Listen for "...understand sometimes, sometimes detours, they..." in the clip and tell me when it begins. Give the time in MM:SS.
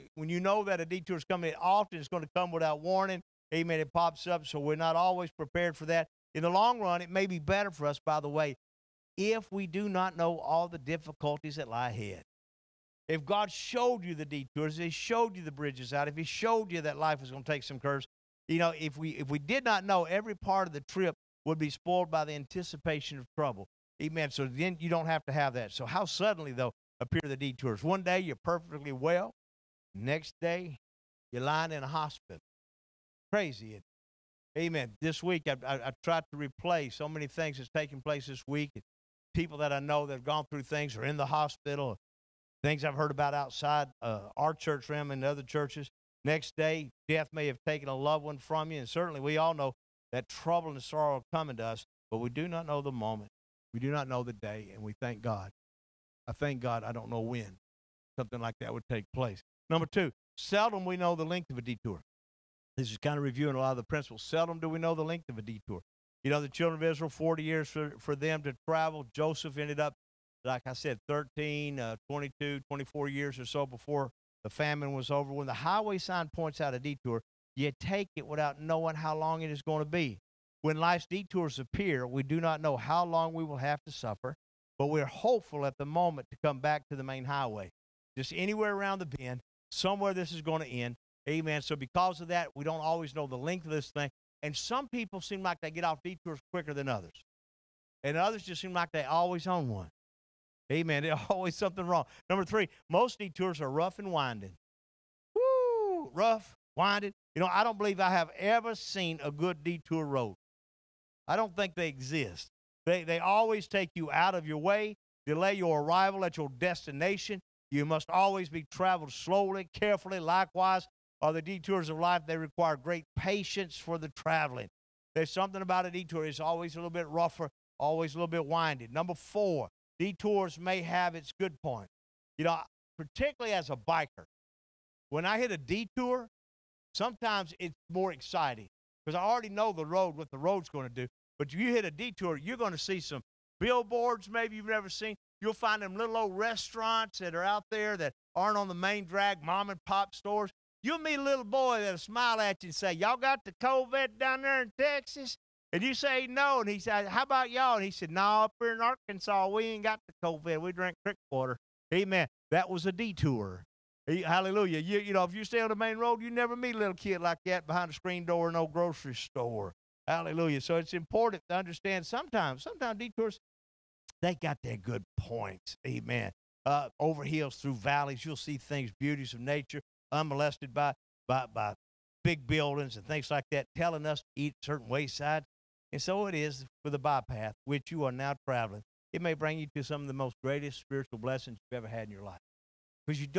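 02:51.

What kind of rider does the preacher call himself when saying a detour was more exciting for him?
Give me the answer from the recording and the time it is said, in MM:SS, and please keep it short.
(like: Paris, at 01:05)
Biker, at 02:13.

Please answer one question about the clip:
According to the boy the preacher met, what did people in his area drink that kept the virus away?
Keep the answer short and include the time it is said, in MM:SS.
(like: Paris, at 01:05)
Creek water, at 02:41.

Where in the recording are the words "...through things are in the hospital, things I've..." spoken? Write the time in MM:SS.
00:40.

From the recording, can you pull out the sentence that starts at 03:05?
And so it is for the bypath which you are now traveling.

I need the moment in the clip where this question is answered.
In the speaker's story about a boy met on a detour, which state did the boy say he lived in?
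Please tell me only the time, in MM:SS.
02:38.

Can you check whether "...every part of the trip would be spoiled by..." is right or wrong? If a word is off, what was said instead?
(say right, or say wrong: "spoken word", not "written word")
right.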